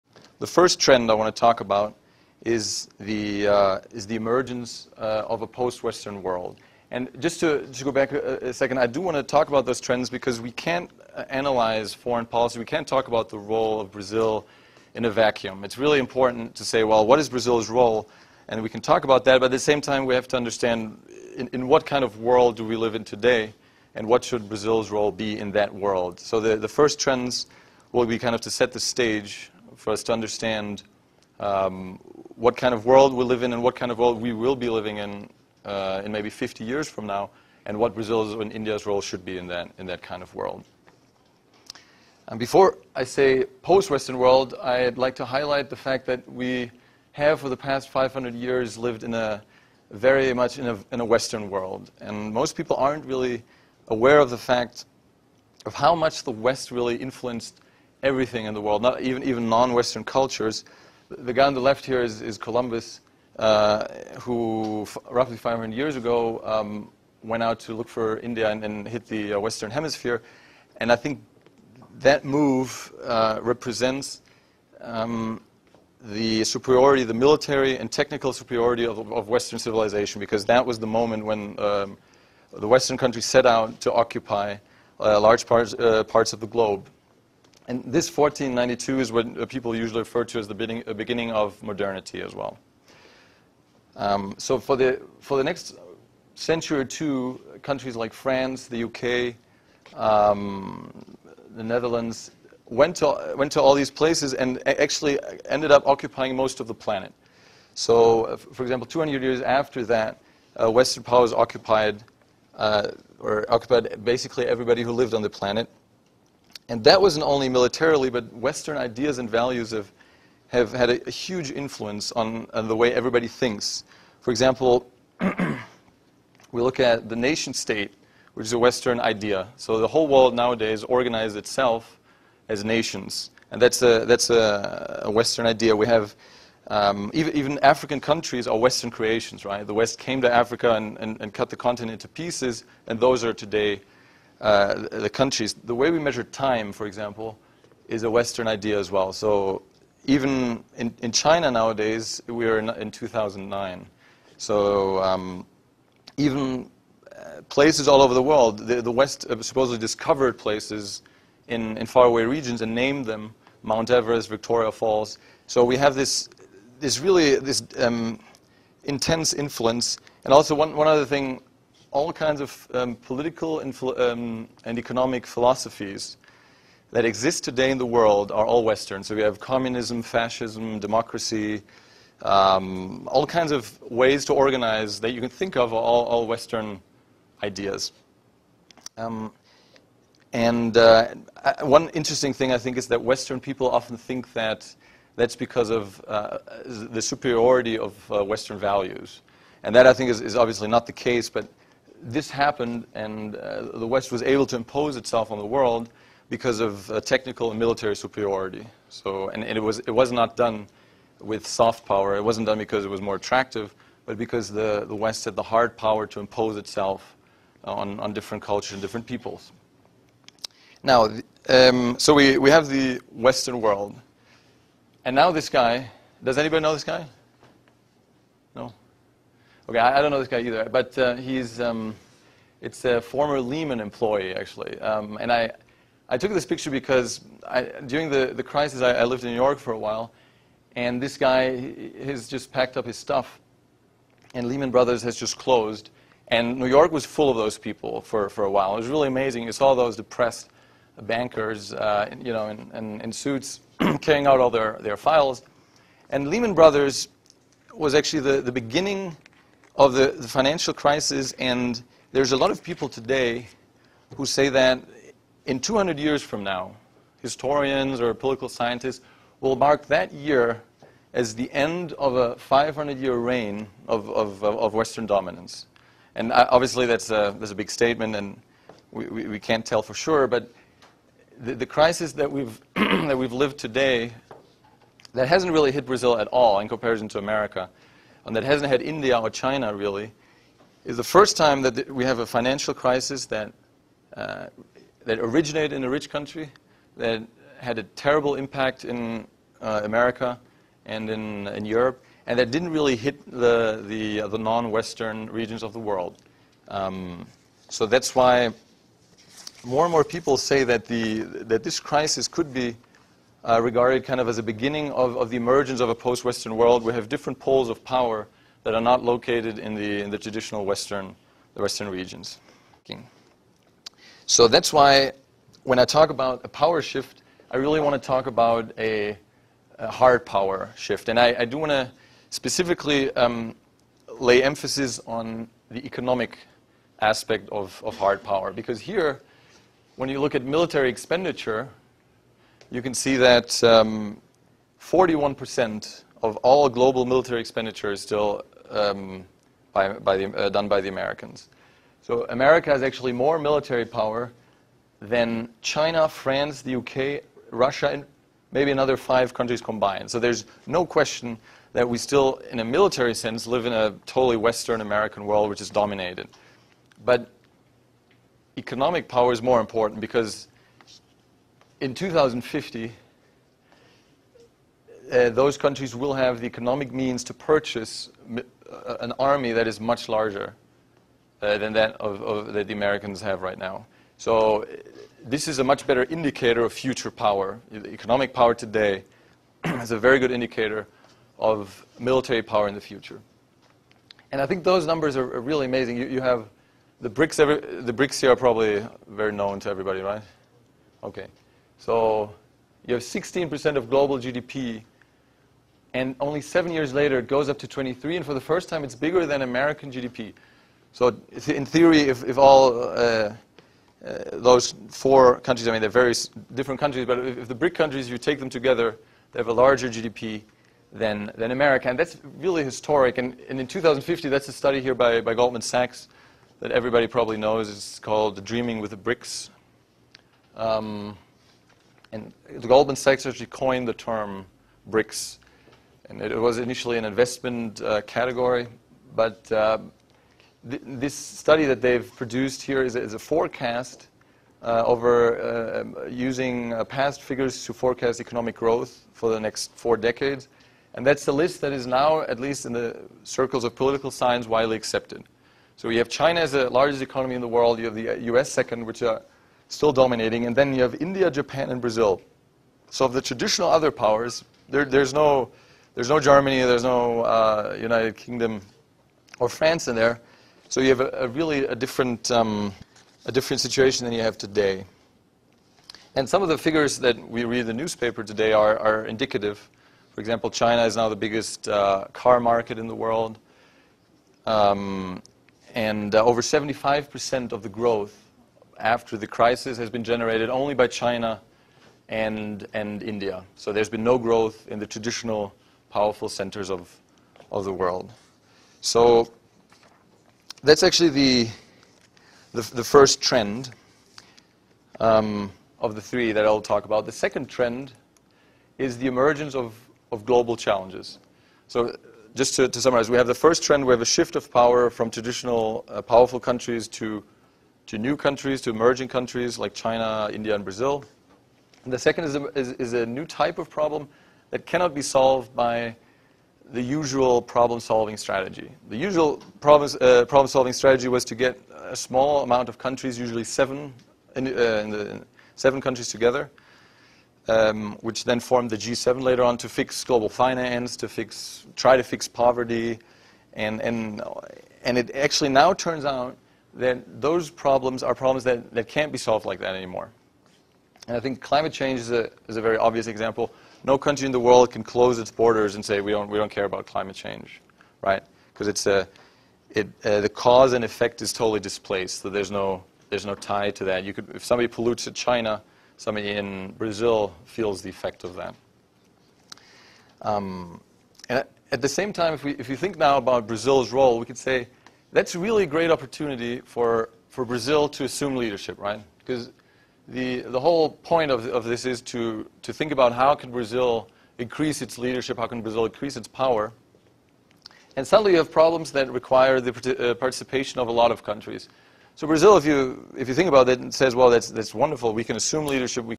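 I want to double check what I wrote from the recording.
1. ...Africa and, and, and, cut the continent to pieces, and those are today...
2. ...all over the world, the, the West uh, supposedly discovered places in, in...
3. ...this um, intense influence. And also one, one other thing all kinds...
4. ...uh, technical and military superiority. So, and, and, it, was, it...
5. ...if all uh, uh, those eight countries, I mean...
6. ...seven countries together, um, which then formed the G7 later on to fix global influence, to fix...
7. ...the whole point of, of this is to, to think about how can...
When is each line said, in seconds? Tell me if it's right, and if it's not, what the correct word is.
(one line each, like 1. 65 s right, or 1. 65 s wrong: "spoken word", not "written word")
1. 140 s right
2. 157 s right
3. 167 s right
4. 206 s right
5. 412 s wrong: "four", not "eight"
6. 535 s wrong: "finance", not "influence"
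7. 580 s right.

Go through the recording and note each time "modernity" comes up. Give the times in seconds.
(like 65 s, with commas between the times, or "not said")
91 s.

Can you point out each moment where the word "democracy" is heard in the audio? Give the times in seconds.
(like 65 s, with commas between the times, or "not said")
180 s.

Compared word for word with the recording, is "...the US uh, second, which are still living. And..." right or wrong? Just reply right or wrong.
wrong.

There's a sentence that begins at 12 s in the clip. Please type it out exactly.
We can't talk about the role of Brazil in a vacuum.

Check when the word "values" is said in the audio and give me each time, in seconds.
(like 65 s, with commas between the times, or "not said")
119 s, 198 s.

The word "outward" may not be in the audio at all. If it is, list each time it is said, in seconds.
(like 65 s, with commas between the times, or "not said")
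not said.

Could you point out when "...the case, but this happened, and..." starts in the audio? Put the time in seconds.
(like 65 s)
200 s.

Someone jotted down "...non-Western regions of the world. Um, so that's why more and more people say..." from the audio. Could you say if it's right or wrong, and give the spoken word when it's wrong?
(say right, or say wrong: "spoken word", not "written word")
right.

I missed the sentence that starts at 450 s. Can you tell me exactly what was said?
And that's the list that is now, at least in the circles of political science, widely accepted.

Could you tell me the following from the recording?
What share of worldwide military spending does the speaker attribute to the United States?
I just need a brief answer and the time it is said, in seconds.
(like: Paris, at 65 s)
41%, at 344 s.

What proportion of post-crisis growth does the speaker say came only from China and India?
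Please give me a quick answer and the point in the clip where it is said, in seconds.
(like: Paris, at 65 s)
Over 75%, at 486 s.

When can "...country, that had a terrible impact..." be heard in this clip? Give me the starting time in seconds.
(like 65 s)
296 s.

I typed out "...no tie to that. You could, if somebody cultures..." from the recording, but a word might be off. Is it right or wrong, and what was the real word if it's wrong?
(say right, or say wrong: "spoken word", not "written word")
wrong: "pollutes", not "cultures".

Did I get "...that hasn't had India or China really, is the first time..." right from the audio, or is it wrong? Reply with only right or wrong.
right.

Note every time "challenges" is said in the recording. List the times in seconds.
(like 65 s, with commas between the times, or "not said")
510 s.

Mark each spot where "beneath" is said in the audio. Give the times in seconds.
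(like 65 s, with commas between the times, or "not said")
not said.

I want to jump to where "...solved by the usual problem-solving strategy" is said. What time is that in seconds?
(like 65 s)
525 s.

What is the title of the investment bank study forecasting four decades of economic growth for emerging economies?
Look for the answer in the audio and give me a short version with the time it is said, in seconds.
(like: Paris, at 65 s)
Dreaming with the BRICS, at 428 s.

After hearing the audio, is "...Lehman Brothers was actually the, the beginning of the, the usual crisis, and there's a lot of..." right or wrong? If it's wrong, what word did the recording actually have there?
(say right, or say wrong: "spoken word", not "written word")
wrong: "financial", not "usual".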